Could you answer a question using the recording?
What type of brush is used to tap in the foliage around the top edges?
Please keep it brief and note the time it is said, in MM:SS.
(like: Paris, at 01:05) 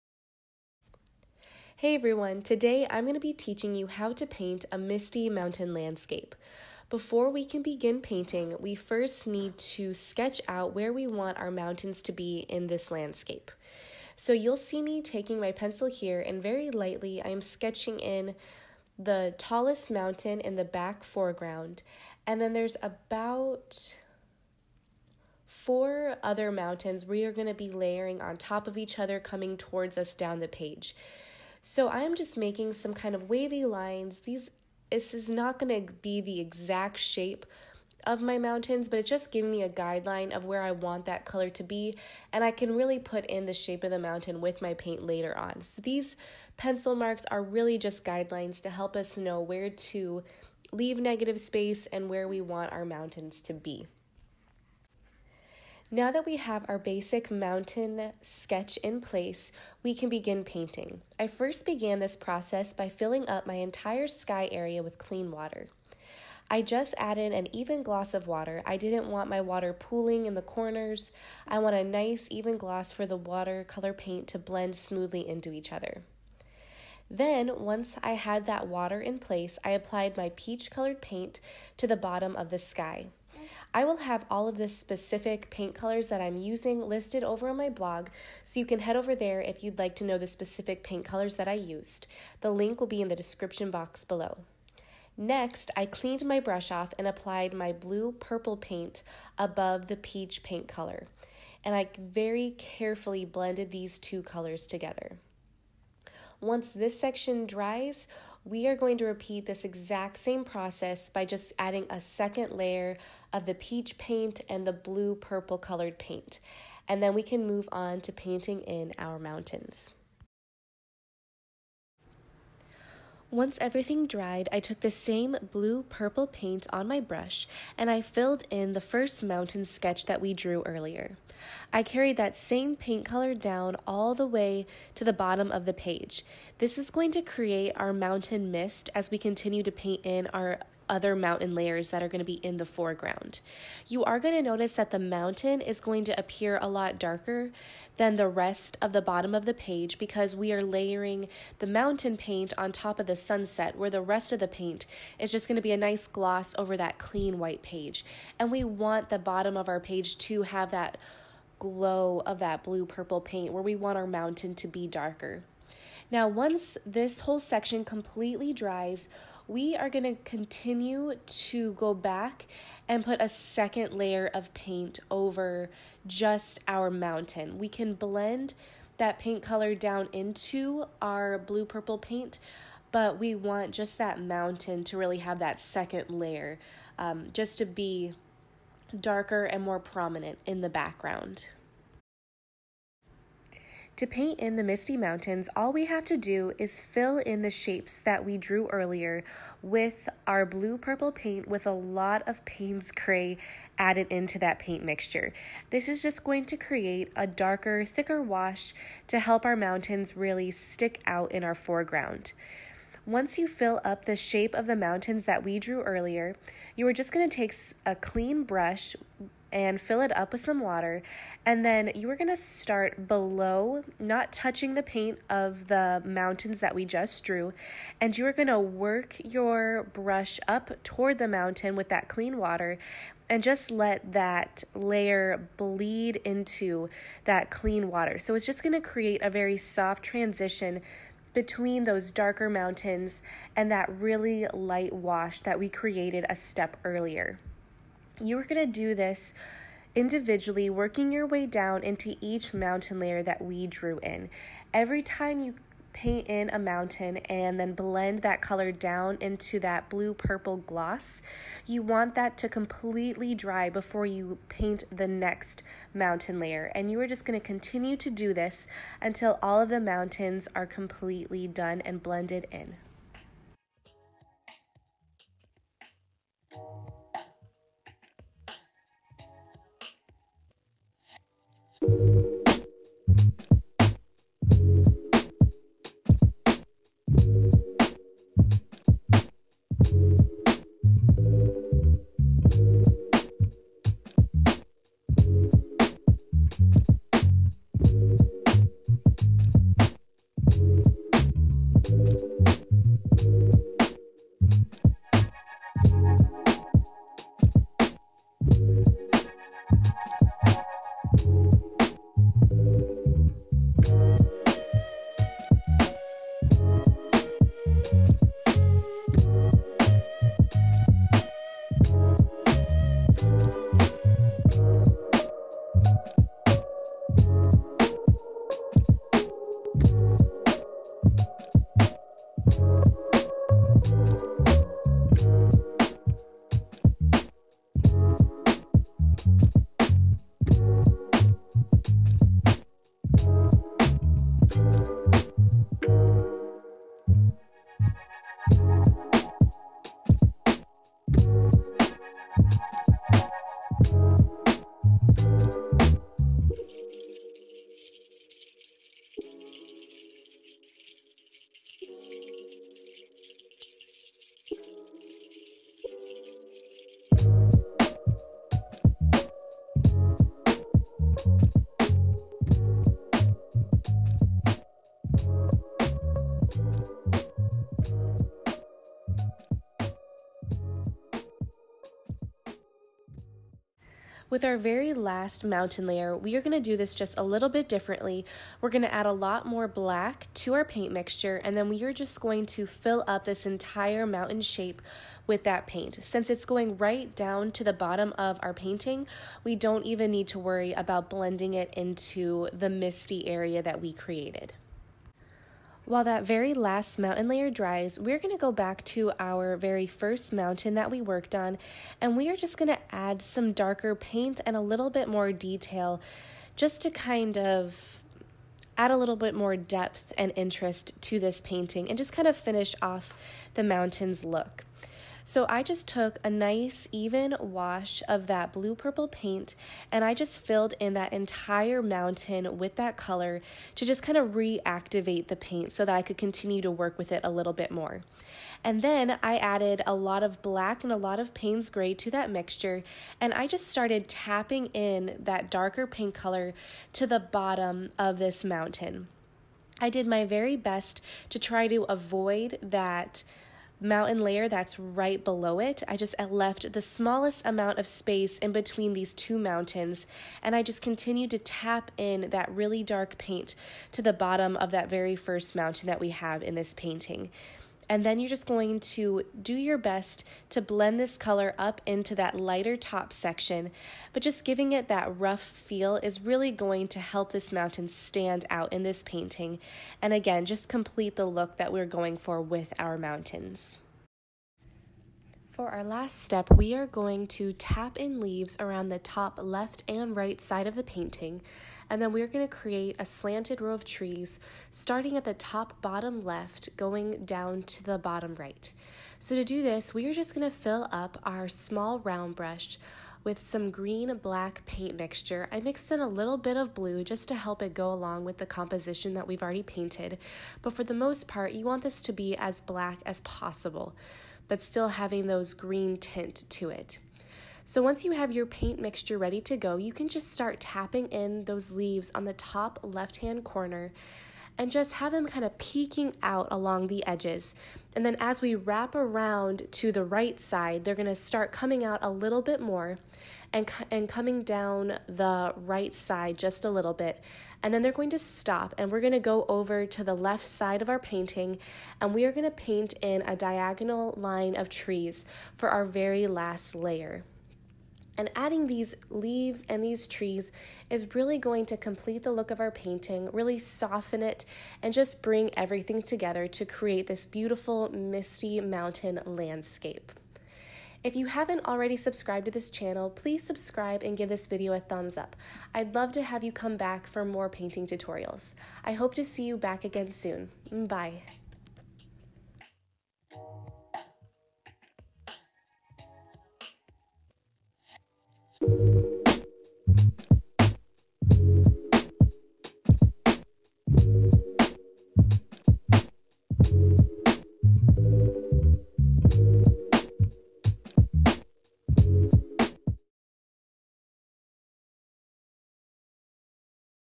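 Small round brush, at 08:21.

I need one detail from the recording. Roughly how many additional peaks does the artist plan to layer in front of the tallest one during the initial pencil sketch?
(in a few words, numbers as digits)
4.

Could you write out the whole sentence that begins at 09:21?
If you haven't already subscribed to this channel, please subscribe and give this video a thumbs up.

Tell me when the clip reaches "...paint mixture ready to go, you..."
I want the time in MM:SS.
08:38.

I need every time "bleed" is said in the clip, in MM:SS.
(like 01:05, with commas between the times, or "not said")
03:55.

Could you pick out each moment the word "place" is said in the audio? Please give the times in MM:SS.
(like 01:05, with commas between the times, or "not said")
00:59, 01:19.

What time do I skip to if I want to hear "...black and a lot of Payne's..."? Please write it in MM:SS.
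07:20.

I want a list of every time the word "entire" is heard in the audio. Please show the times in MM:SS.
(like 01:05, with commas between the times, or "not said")
01:03, 06:33, 07:11.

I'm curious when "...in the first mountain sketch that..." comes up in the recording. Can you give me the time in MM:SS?
02:08.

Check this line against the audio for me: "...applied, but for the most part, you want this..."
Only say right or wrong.
wrong.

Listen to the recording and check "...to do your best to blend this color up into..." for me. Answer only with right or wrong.
right.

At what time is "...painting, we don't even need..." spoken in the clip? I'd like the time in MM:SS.
06:38.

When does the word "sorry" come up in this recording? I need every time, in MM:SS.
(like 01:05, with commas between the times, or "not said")
not said.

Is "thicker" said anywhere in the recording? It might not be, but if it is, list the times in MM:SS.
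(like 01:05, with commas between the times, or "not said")
03:27.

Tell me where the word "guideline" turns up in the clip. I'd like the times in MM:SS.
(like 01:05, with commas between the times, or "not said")
00:39, 00:48.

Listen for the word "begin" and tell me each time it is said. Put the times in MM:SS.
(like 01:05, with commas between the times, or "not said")
00:07, 01:00.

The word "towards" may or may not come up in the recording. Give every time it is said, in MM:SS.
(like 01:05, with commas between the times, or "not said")
00:29, 03:50.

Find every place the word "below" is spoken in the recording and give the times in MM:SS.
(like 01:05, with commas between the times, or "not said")
01:34, 03:43, 07:35.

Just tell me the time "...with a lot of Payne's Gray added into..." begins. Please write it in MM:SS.
03:21.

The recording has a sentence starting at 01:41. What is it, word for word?
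And I very carefully blended these two colors together.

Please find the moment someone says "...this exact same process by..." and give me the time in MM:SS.
01:49.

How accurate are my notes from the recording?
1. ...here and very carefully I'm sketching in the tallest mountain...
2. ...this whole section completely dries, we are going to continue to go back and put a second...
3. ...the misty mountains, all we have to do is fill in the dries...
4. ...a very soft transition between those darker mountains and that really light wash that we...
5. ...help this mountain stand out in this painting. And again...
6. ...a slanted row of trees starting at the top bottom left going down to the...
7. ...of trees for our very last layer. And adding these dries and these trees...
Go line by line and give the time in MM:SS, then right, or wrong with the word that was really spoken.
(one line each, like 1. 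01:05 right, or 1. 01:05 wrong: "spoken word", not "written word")
1. 00:15 wrong: "lightly", not "carefully"
2. 02:46 right
3. 03:14 wrong: "shapes", not "dries"
4. 03:59 right
5. 07:57 right
6. 08:12 right
7. 09:04 wrong: "leaves", not "dries".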